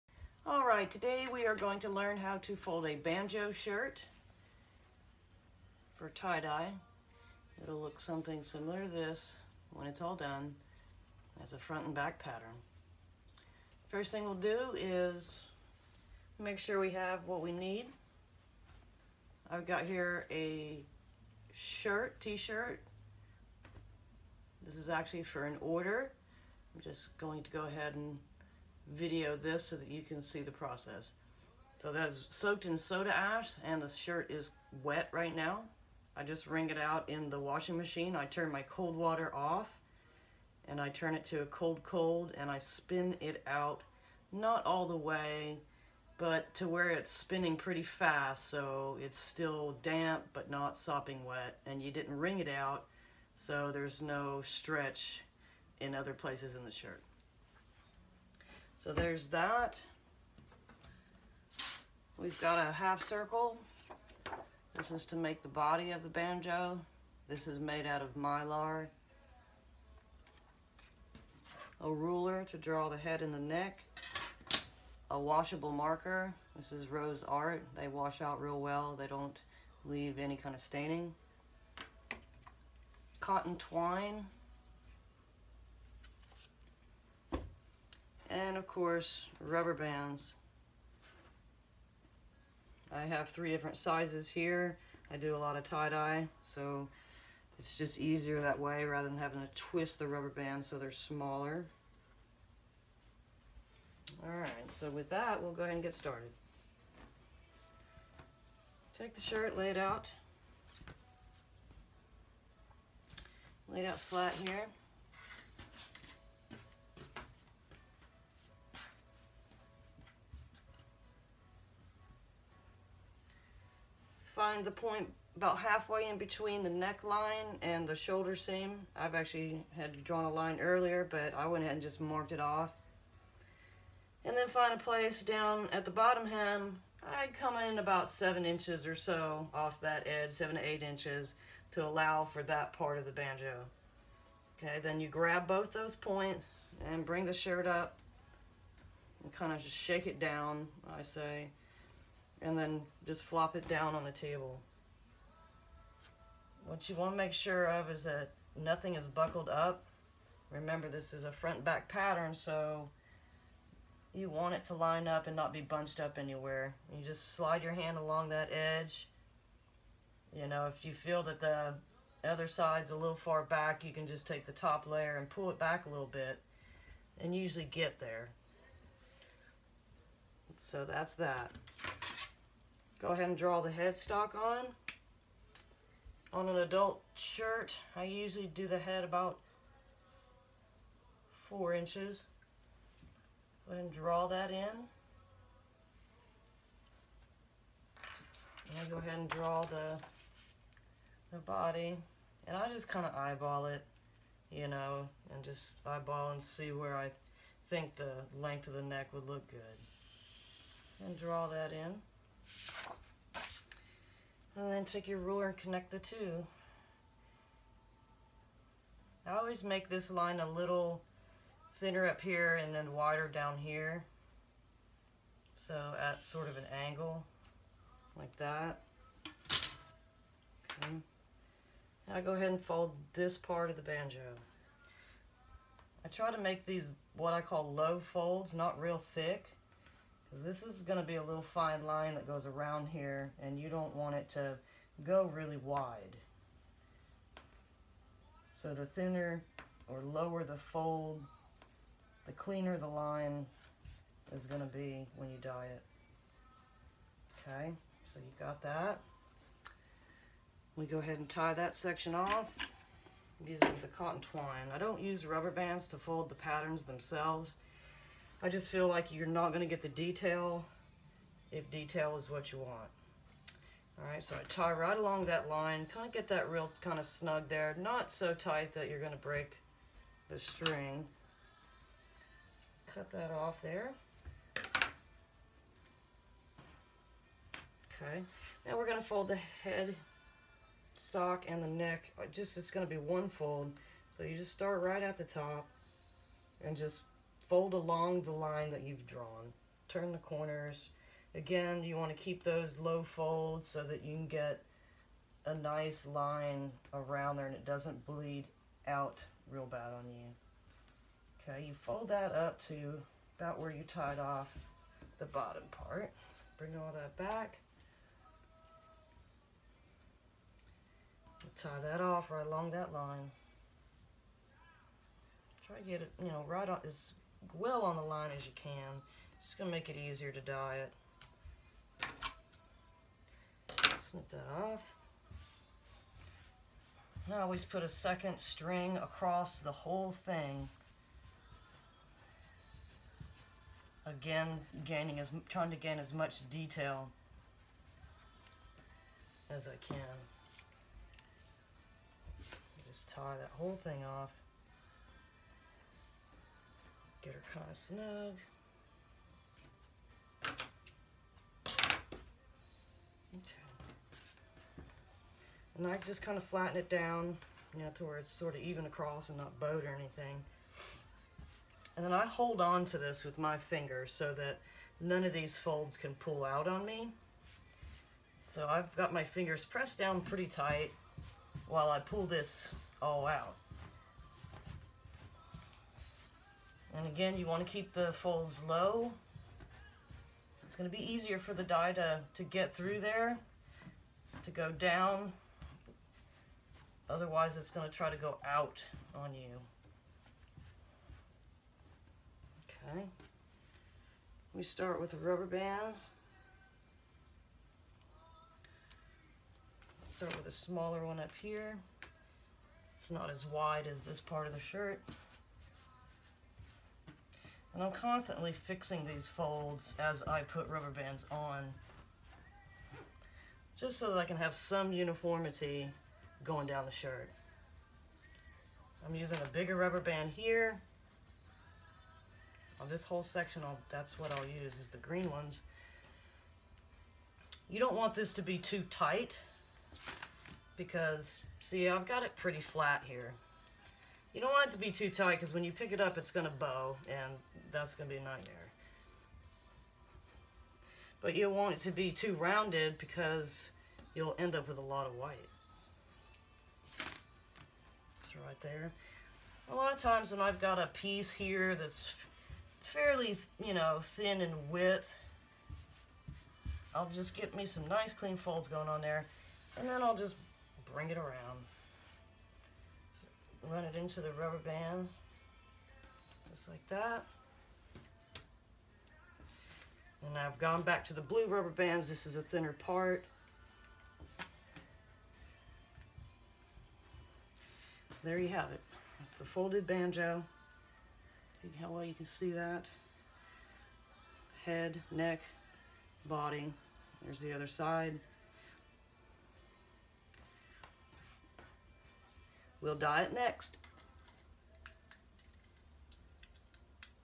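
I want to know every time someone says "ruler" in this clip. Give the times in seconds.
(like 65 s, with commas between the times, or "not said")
71 s, 215 s.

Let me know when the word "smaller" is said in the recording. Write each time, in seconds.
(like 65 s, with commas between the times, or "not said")
100 s, 410 s.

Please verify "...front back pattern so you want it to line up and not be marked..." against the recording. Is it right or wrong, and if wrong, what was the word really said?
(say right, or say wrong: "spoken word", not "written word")
wrong: "bunched", not "marked".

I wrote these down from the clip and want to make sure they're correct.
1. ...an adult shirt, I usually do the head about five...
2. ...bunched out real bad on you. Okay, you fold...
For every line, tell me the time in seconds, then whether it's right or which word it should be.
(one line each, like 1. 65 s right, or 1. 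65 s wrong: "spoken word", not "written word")
1. 186 s wrong: "four", not "five"
2. 308 s wrong: "bleed", not "bunched".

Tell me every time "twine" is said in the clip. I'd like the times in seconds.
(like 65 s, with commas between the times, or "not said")
83 s, 264 s.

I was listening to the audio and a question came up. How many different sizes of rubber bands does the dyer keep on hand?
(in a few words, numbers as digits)
3.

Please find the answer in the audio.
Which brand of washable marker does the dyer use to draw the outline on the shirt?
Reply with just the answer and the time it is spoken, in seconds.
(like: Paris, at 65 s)
Rose Art, at 76 s.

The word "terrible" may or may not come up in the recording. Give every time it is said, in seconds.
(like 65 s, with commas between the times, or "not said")
not said.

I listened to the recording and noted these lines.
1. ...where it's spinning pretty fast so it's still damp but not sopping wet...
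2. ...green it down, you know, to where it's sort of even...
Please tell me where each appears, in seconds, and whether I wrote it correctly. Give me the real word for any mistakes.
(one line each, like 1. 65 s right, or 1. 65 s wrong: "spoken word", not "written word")
1. 46 s right
2. 366 s wrong: "flatten", not "green".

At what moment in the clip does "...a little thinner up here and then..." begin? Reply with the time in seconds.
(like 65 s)
220 s.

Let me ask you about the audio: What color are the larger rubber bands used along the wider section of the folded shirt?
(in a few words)
Green.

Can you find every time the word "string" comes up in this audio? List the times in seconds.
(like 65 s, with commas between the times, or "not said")
280 s, 338 s.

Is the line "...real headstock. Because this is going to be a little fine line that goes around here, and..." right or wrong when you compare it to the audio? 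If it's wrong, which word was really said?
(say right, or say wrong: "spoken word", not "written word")
wrong: "thick", not "headstock".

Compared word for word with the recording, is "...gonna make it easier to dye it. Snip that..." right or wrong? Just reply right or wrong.
right.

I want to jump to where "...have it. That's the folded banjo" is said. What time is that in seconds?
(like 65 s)
488 s.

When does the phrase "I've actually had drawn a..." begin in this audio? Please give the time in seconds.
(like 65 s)
128 s.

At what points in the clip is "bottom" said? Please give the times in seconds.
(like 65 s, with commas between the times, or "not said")
135 s, 315 s.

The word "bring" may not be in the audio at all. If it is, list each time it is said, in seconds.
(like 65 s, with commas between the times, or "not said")
147 s, 316 s, 470 s.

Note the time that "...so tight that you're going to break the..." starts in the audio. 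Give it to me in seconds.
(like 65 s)
278 s.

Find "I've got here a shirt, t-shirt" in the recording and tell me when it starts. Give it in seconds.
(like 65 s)
19 s.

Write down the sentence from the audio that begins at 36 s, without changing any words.
I just wring it out in the washing machine.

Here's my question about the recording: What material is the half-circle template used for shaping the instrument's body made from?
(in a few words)
Mylar.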